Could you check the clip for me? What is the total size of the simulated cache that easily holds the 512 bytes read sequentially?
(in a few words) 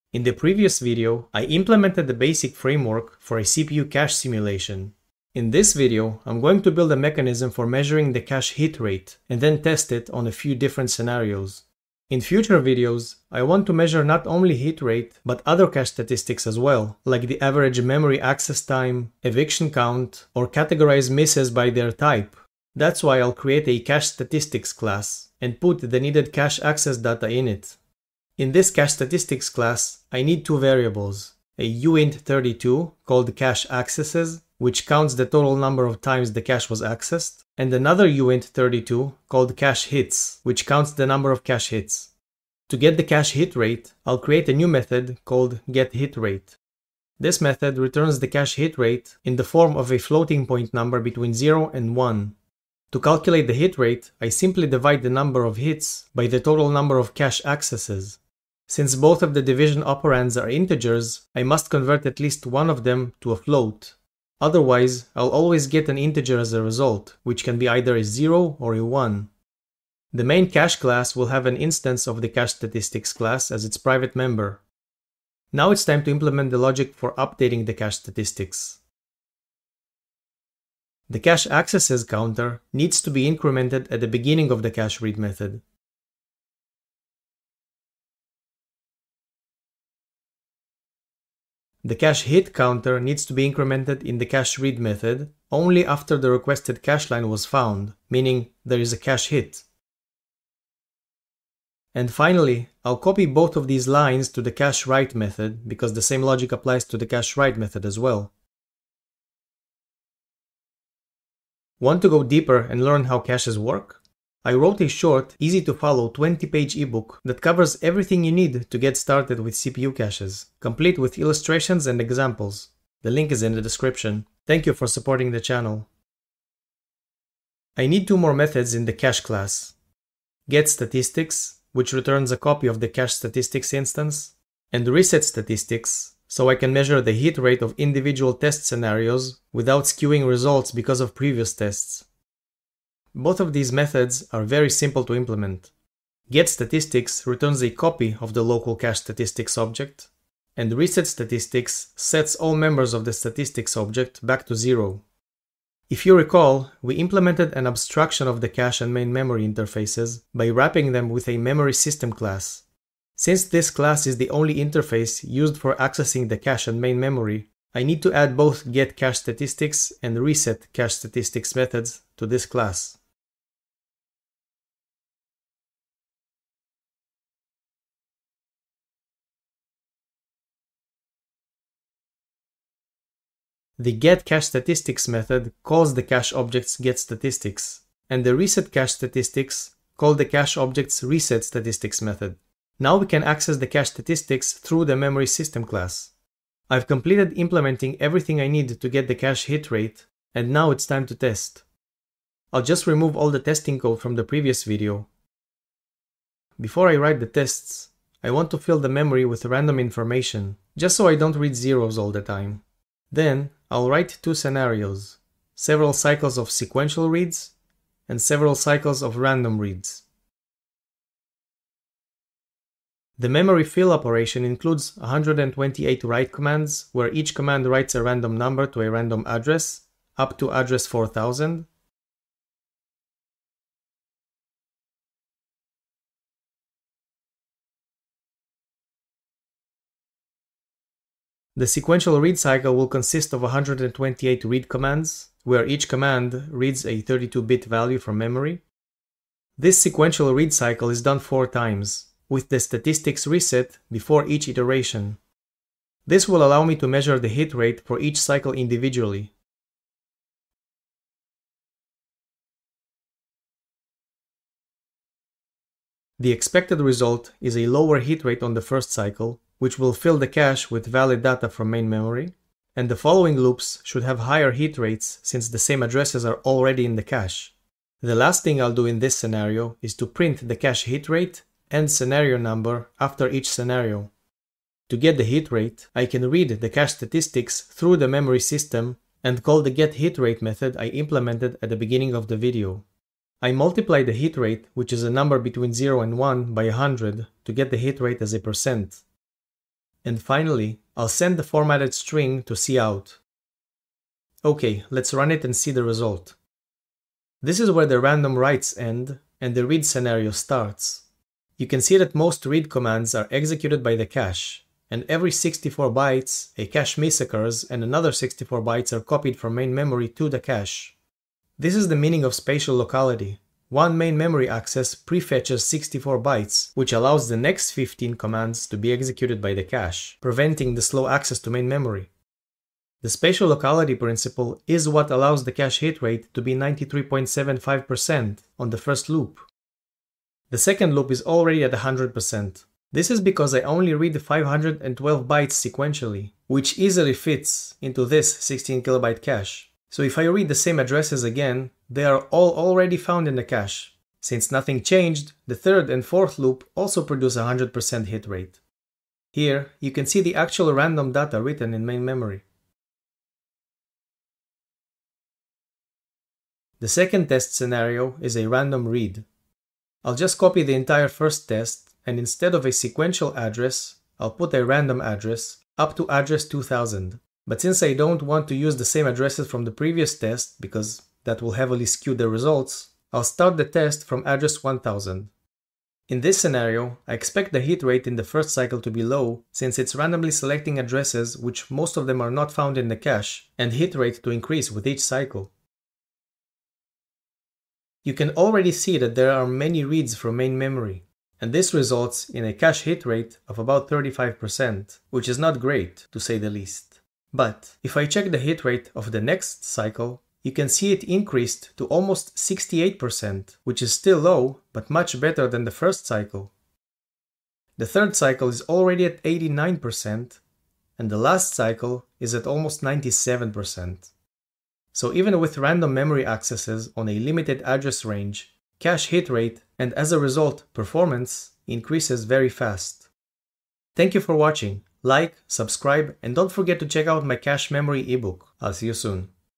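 16 kilobytes.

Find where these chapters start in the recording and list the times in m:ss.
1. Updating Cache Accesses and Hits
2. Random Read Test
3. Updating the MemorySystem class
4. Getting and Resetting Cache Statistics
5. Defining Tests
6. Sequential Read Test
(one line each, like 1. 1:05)
1. 1:20
2. 6:06
3. 2:45
4. 2:06
5. 3:20
6. 3:40.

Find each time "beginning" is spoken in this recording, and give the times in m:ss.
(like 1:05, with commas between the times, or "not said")
1:24, 4:51.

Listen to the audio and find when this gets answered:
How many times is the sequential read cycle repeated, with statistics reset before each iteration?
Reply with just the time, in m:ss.
4:11.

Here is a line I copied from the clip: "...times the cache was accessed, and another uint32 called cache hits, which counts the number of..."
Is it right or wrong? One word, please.
right.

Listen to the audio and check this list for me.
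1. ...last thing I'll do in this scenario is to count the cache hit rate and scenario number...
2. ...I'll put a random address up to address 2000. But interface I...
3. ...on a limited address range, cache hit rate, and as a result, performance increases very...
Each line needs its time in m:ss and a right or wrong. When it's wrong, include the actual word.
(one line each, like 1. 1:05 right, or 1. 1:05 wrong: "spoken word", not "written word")
1. 4:38 wrong: "print", not "count"
2. 6:14 wrong: "since", not "interface"
3. 7:06 right.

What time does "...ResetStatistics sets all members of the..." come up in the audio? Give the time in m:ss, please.
2:30.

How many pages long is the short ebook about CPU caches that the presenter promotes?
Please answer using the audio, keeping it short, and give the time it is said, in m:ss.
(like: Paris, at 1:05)
20, at 1:56.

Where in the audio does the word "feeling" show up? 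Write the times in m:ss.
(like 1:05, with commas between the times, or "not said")
not said.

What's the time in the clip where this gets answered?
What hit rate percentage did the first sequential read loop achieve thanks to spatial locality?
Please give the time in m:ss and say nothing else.
5:36.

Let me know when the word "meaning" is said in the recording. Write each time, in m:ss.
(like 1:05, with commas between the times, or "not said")
1:38, 5:21.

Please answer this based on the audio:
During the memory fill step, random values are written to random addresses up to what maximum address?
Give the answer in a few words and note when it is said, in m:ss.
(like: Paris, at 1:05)
4000, at 3:50.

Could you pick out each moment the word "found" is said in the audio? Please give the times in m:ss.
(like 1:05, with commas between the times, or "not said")
1:37, 5:52, 6:32.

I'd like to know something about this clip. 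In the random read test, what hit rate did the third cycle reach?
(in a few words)
89%.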